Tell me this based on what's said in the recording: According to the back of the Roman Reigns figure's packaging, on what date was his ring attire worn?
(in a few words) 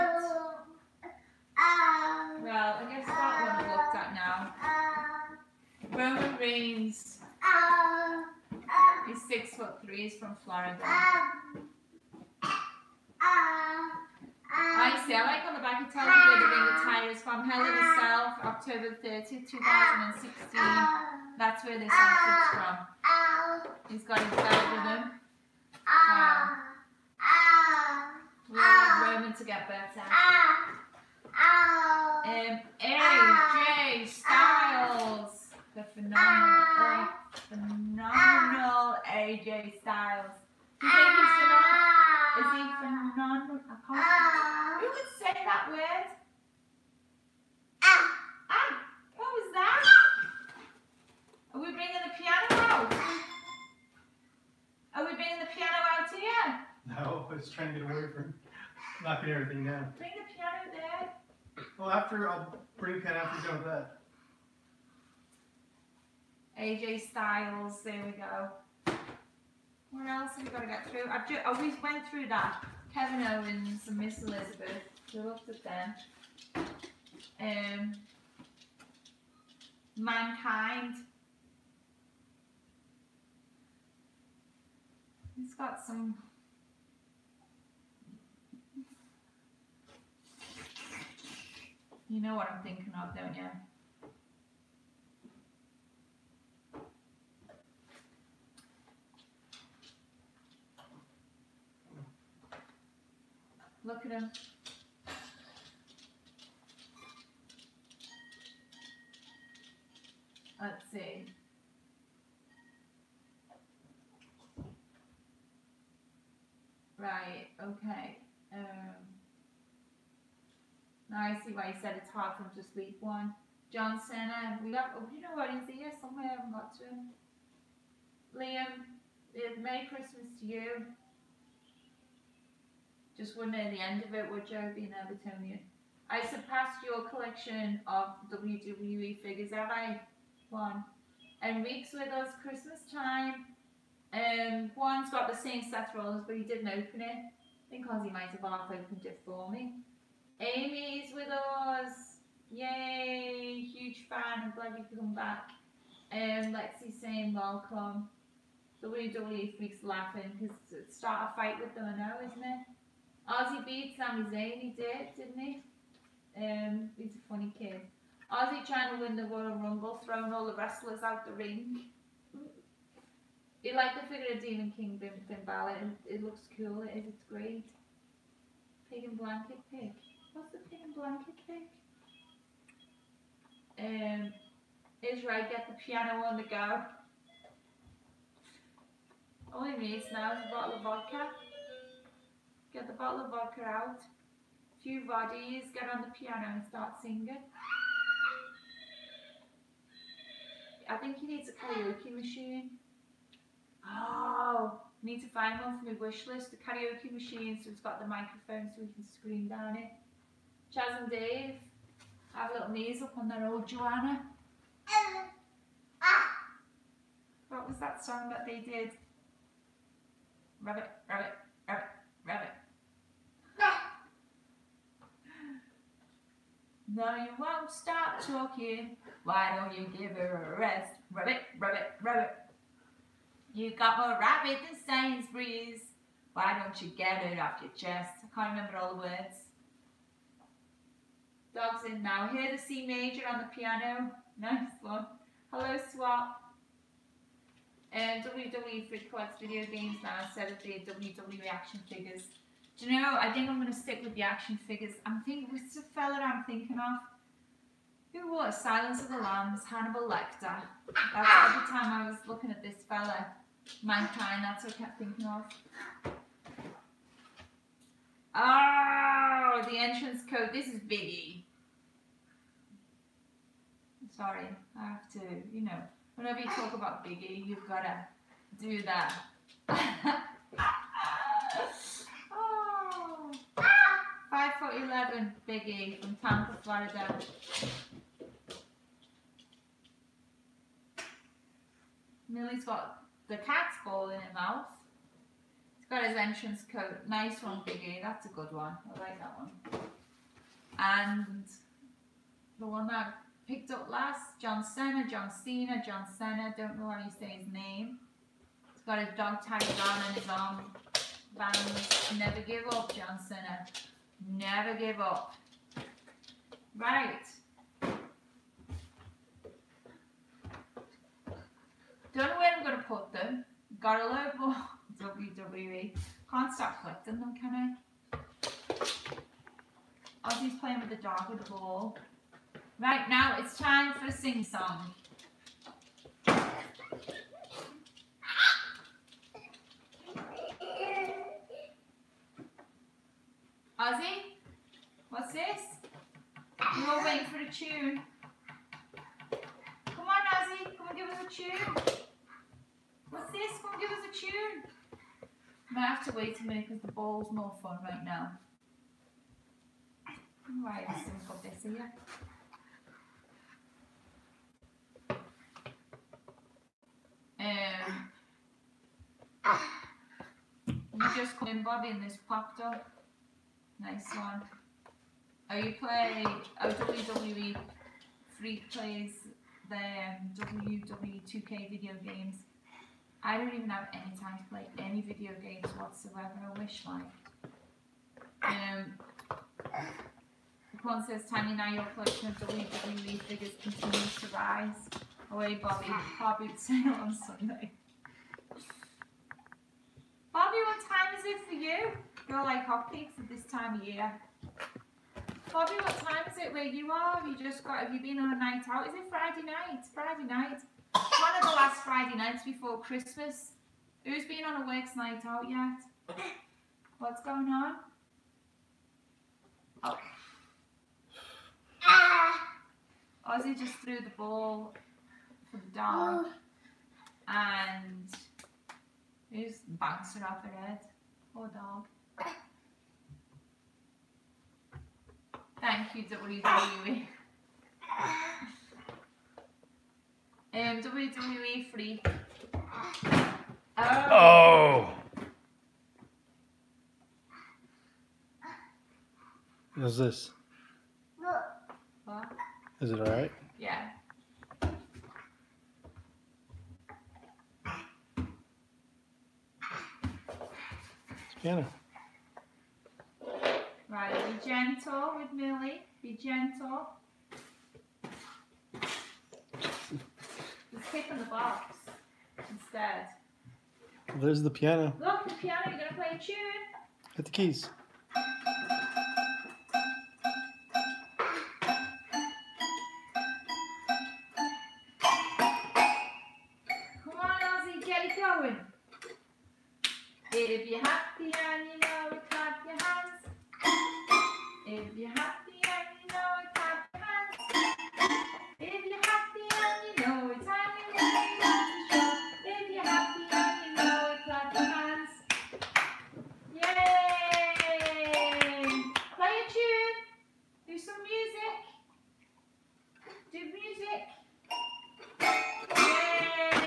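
October 30th, 2016.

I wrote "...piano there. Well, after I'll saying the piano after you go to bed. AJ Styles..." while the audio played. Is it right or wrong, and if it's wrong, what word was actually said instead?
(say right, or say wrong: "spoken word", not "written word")
wrong: "bring", not "saying".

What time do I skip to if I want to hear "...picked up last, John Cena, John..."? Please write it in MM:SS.
05:03.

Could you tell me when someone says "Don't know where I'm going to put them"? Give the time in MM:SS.
05:22.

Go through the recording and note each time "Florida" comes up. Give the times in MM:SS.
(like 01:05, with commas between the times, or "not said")
00:10, 04:46.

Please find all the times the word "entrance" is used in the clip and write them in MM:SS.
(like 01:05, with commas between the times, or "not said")
04:29, 04:56.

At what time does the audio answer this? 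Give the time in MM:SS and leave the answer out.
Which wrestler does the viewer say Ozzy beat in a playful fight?
02:43.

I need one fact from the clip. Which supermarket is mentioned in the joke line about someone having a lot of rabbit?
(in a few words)
Sainsbury's.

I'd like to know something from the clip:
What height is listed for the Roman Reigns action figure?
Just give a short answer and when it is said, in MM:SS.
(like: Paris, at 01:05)
6 foot 3, at 00:09.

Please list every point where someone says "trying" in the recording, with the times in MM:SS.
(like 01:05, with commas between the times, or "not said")
00:57, 02:48.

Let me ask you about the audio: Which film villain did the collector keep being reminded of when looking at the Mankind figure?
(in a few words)
Hannibal Lecter.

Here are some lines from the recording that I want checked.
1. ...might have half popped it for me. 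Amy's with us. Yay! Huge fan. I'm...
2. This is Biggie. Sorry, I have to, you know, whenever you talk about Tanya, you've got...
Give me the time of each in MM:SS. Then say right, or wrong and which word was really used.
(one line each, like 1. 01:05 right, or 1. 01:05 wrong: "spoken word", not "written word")
1. 02:28 wrong: "opened", not "popped"
2. 04:30 wrong: "Biggie", not "Tanya".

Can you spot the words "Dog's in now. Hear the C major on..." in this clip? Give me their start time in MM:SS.
04:01.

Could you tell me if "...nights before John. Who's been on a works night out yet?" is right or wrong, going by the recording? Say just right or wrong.
wrong.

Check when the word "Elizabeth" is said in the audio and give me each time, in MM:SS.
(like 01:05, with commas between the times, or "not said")
01:14.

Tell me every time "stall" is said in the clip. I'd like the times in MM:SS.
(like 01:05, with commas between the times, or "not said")
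not said.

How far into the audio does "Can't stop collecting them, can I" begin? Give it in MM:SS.
05:26.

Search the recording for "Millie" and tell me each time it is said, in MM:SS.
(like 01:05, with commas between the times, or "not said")
04:52, 07:45.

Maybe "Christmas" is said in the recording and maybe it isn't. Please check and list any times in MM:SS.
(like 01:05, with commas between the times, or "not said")
02:09, 02:22, 06:52.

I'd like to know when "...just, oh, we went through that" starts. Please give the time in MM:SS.
01:11.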